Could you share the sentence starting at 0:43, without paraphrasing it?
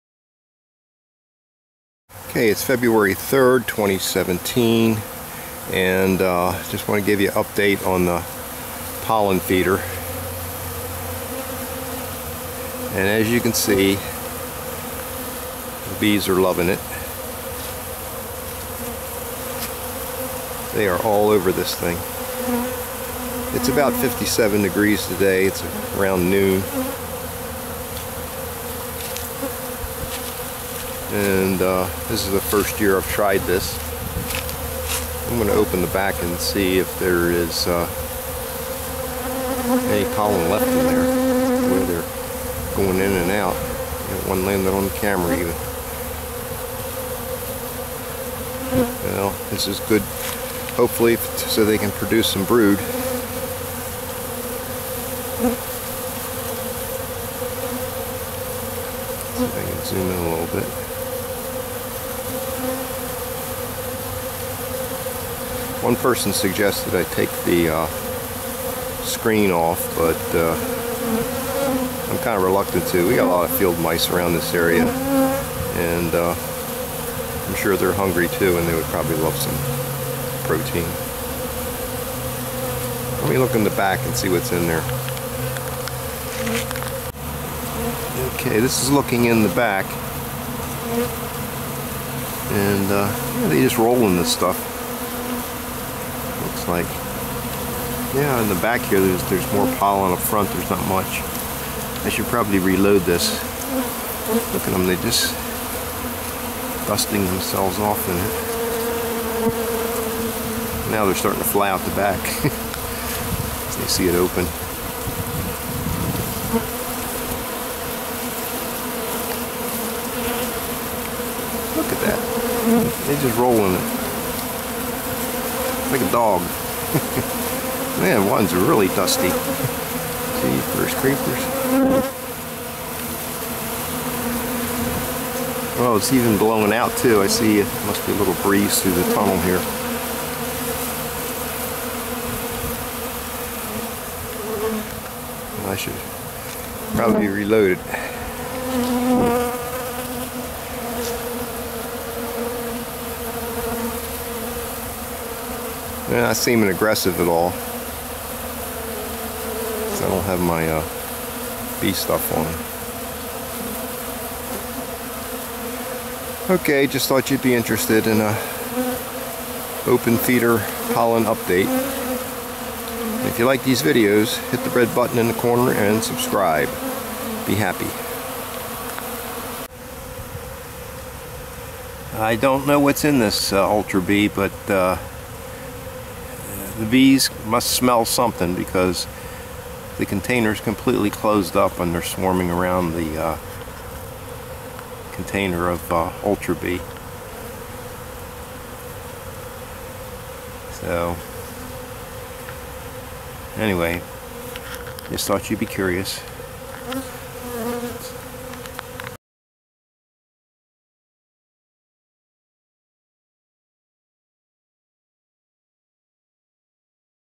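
Got one landed on the camera even.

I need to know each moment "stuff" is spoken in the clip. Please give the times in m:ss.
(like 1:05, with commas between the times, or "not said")
1:34, 2:41.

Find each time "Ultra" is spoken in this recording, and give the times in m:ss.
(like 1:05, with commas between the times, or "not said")
3:03, 3:16.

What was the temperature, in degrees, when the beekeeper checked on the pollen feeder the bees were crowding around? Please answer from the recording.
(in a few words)
57 degrees.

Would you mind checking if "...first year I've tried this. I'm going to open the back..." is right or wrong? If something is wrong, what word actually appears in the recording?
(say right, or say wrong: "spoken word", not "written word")
right.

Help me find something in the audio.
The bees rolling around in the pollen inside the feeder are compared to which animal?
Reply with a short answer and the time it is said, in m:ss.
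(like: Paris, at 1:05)
A dog, at 2:06.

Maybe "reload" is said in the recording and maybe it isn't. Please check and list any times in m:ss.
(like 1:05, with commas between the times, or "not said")
1:42, 2:27.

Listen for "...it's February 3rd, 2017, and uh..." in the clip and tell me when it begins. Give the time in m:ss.
0:02.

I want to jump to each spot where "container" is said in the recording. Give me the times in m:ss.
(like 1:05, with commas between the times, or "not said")
3:10, 3:15.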